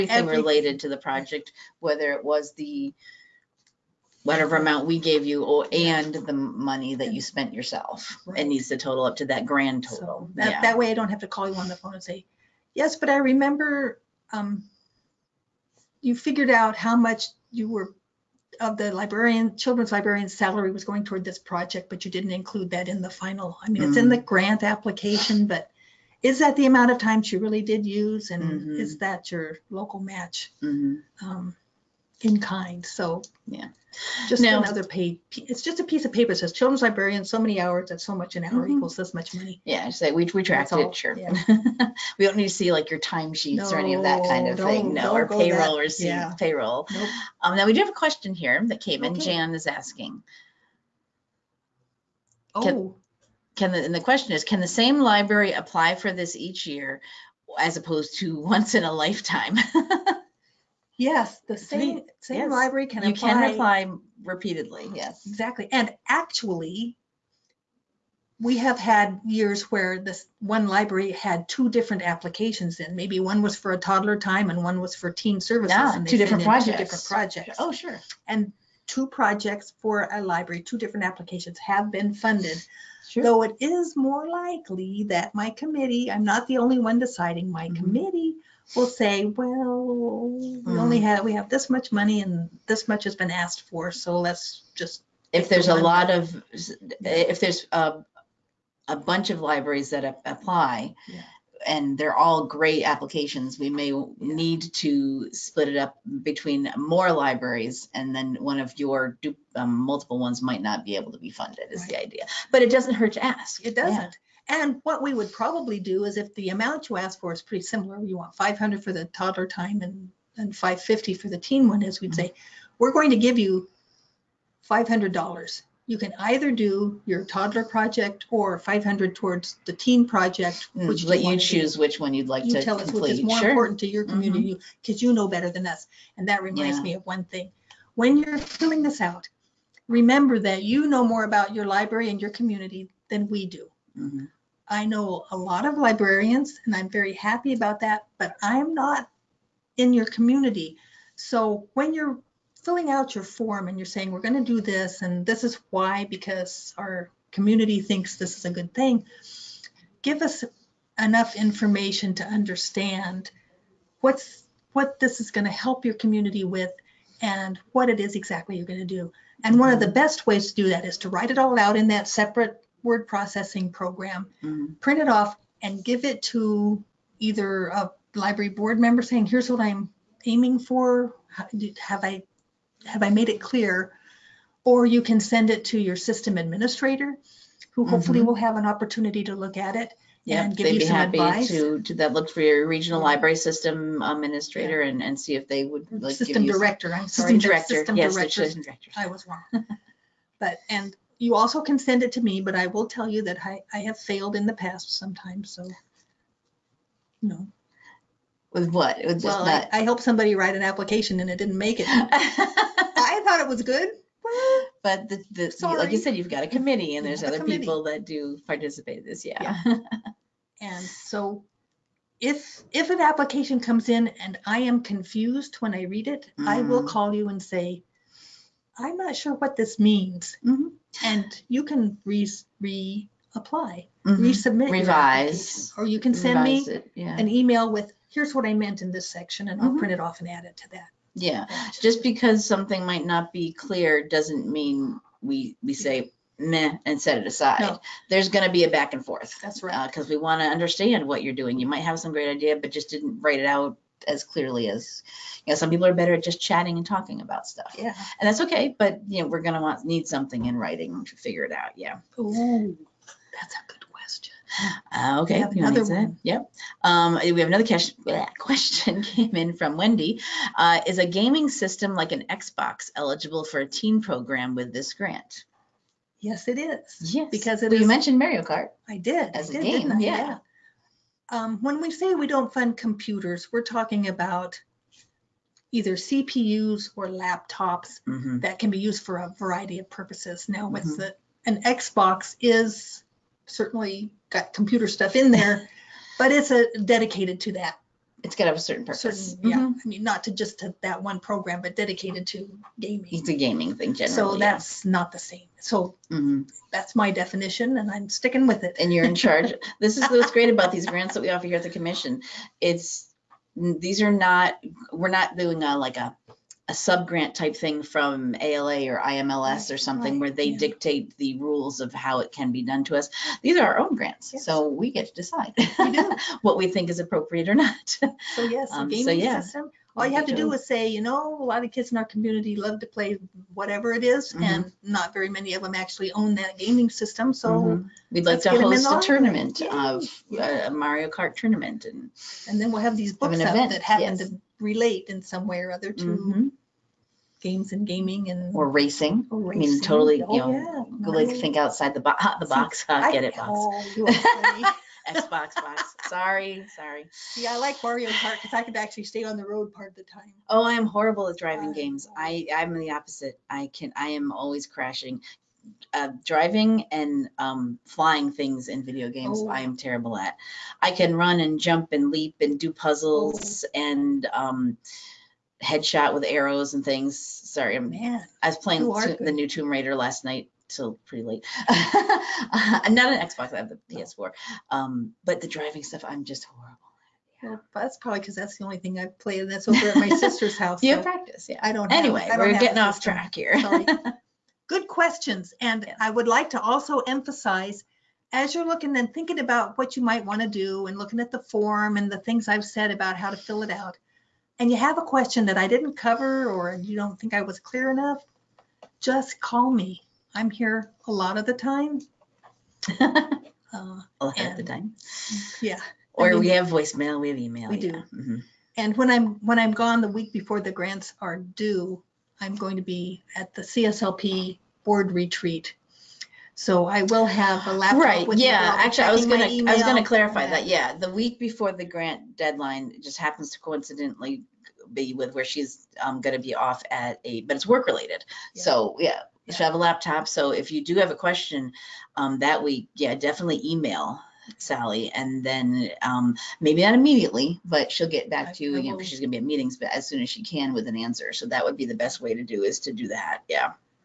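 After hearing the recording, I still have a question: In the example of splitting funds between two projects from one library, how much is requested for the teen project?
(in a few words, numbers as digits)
$550.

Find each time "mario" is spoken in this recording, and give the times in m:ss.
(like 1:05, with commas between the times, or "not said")
4:38, 5:40, 5:57.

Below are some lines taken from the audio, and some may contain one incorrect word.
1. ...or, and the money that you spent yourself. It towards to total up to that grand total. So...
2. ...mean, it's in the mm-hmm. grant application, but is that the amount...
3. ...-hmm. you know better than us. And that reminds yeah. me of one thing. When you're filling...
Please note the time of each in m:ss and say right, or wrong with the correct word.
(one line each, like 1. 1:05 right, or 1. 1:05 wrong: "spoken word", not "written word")
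1. 0:05 wrong: "needs", not "towards"
2. 0:23 right
3. 2:14 right.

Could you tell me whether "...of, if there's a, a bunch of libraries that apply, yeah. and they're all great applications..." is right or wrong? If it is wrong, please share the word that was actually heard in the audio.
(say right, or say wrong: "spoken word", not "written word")
right.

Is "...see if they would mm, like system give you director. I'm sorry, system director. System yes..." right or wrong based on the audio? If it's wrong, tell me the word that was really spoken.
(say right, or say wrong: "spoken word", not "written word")
right.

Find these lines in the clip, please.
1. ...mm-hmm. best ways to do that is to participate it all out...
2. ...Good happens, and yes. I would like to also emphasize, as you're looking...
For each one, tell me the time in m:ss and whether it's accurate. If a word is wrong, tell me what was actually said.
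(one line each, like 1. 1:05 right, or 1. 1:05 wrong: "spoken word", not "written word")
1. 2:49 wrong: "write", not "participate"
2. 6:34 wrong: "questions", not "happens".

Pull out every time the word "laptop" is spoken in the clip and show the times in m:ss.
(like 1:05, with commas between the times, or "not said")
4:47, 7:07, 7:19.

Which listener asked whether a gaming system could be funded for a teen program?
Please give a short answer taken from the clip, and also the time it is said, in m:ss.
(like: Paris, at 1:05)
Wendy, at 4:29.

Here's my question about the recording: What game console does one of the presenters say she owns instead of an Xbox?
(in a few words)
PS4.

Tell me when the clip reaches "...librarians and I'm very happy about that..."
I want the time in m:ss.
2:25.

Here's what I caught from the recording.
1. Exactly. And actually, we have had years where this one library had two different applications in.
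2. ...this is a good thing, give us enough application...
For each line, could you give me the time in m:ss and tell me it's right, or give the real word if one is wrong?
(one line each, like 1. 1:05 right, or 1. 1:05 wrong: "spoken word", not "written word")
1. 1:05 right
2. 2:38 wrong: "information", not "application".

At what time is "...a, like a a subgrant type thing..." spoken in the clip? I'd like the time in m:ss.
5:15.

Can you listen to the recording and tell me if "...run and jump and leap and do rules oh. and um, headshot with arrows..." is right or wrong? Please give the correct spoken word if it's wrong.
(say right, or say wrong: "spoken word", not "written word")
wrong: "puzzles", not "rules".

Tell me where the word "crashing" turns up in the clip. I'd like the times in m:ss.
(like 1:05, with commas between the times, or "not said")
6:04.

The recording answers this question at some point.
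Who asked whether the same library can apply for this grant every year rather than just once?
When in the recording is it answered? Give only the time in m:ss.
0:49.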